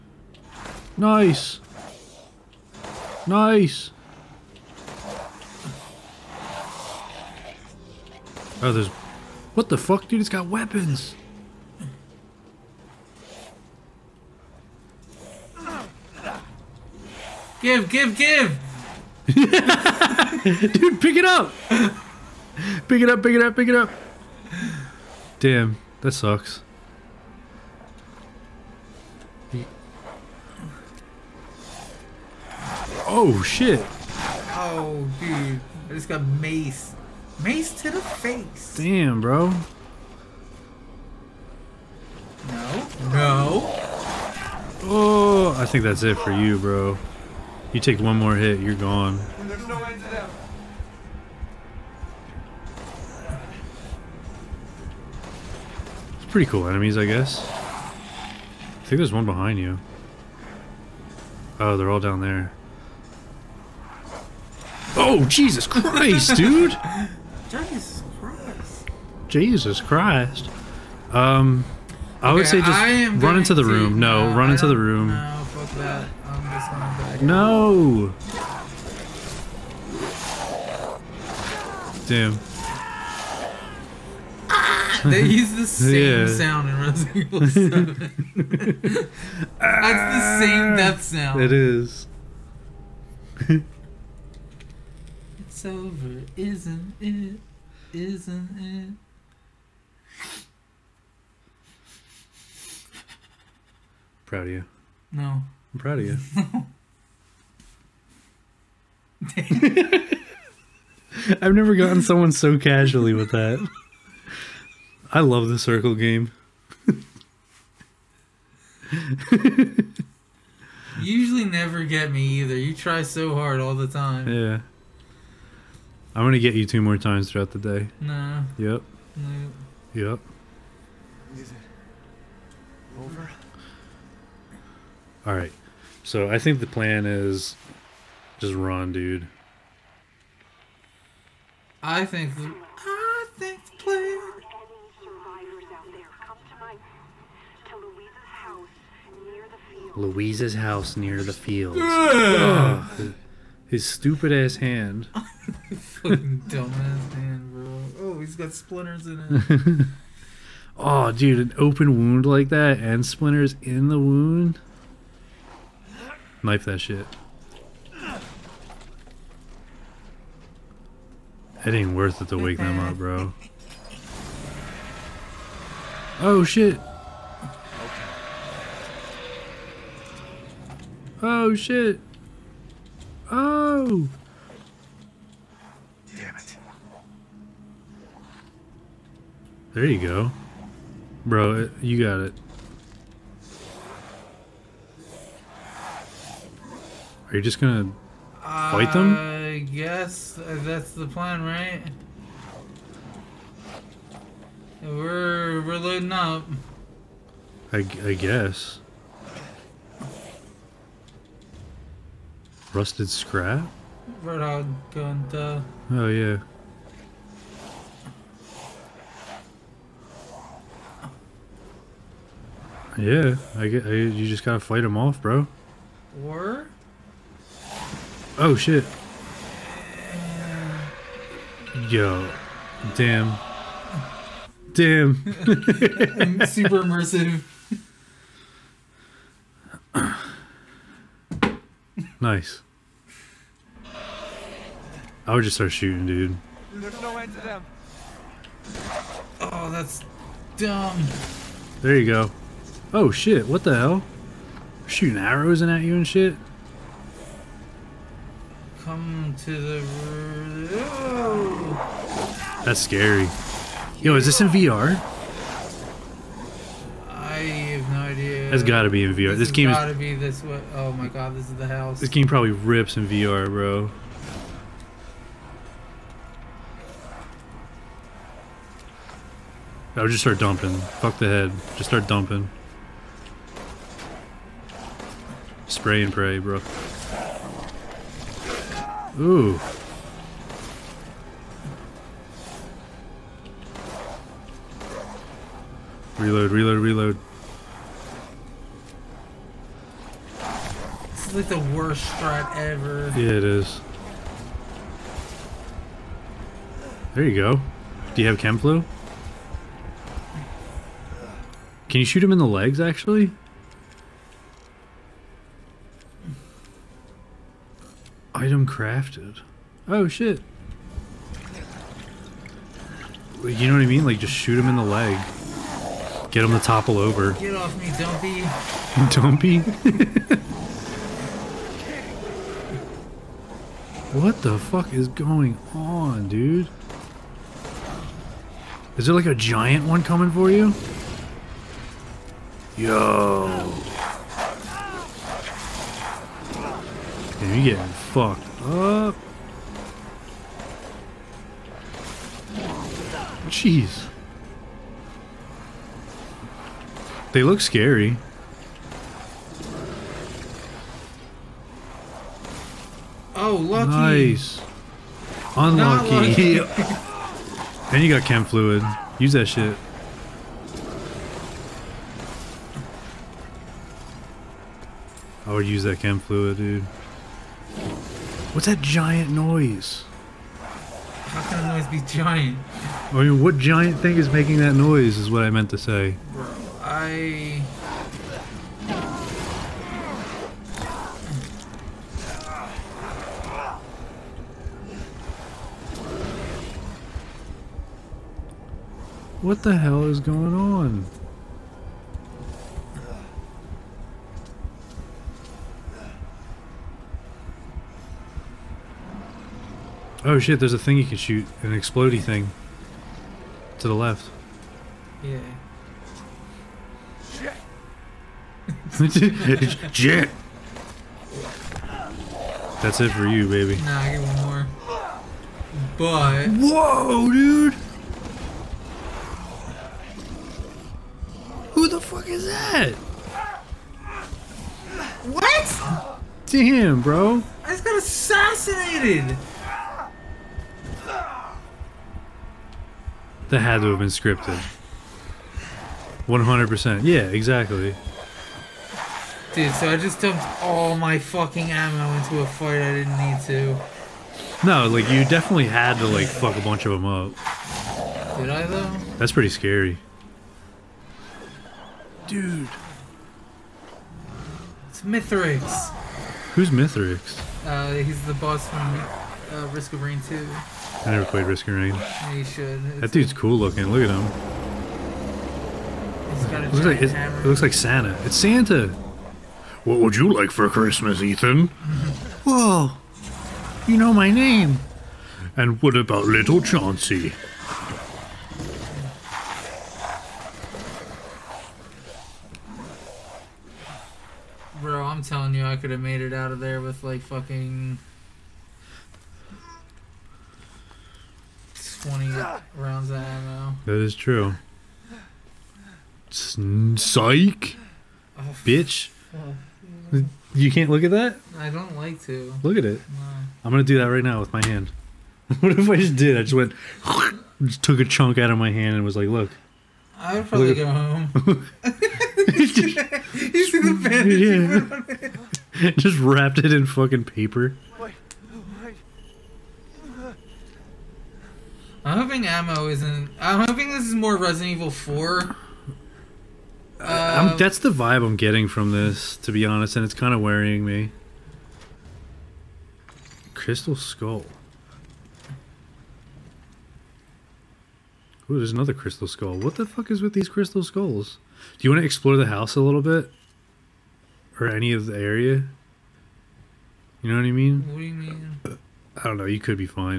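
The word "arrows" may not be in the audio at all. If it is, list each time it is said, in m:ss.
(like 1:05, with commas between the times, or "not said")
4:15.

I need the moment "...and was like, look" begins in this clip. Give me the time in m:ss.
8:38.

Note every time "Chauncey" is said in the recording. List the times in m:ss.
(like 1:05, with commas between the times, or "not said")
8:06.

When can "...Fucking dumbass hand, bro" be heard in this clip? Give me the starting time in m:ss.
2:35.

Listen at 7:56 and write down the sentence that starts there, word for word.
He's got a it looks like it looks like Santa.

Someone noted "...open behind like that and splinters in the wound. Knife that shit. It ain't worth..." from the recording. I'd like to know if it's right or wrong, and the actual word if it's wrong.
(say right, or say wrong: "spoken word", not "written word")
wrong: "wound", not "behind".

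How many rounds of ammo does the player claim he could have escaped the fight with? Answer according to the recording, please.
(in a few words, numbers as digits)
20.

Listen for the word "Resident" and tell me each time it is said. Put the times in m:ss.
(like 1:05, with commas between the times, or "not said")
1:26, 8:54.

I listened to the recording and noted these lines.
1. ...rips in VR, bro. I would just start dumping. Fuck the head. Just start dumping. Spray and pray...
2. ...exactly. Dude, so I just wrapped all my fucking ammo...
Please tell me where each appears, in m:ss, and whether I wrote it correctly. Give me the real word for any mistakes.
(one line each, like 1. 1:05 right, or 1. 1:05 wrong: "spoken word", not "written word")
1. 4:32 right
2. 7:27 wrong: "dumped", not "wrapped".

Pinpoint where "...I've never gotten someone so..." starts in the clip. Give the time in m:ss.
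1:51.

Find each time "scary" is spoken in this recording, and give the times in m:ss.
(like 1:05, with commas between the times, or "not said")
4:22, 5:57, 7:39.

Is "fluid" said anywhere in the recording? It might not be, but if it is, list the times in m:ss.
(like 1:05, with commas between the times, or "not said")
6:08, 6:16.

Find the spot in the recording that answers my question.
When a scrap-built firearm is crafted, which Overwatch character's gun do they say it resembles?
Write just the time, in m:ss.
3:34.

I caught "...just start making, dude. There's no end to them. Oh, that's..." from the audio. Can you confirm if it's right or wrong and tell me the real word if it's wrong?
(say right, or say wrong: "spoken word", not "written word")
wrong: "shooting", not "making".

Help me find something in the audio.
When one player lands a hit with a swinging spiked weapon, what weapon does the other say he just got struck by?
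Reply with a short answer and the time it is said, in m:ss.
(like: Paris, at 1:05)
Mace, at 0:35.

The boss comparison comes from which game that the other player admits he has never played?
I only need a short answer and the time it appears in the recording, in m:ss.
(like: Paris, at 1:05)
Risk of Rain 2, at 7:49.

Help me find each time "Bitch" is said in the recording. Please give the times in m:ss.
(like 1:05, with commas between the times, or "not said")
8:28.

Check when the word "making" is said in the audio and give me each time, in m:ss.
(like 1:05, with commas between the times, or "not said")
6:24.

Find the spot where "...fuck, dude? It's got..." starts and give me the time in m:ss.
0:09.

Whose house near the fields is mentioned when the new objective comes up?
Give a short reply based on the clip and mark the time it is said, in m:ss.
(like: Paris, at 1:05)
Luiza's, at 2:29.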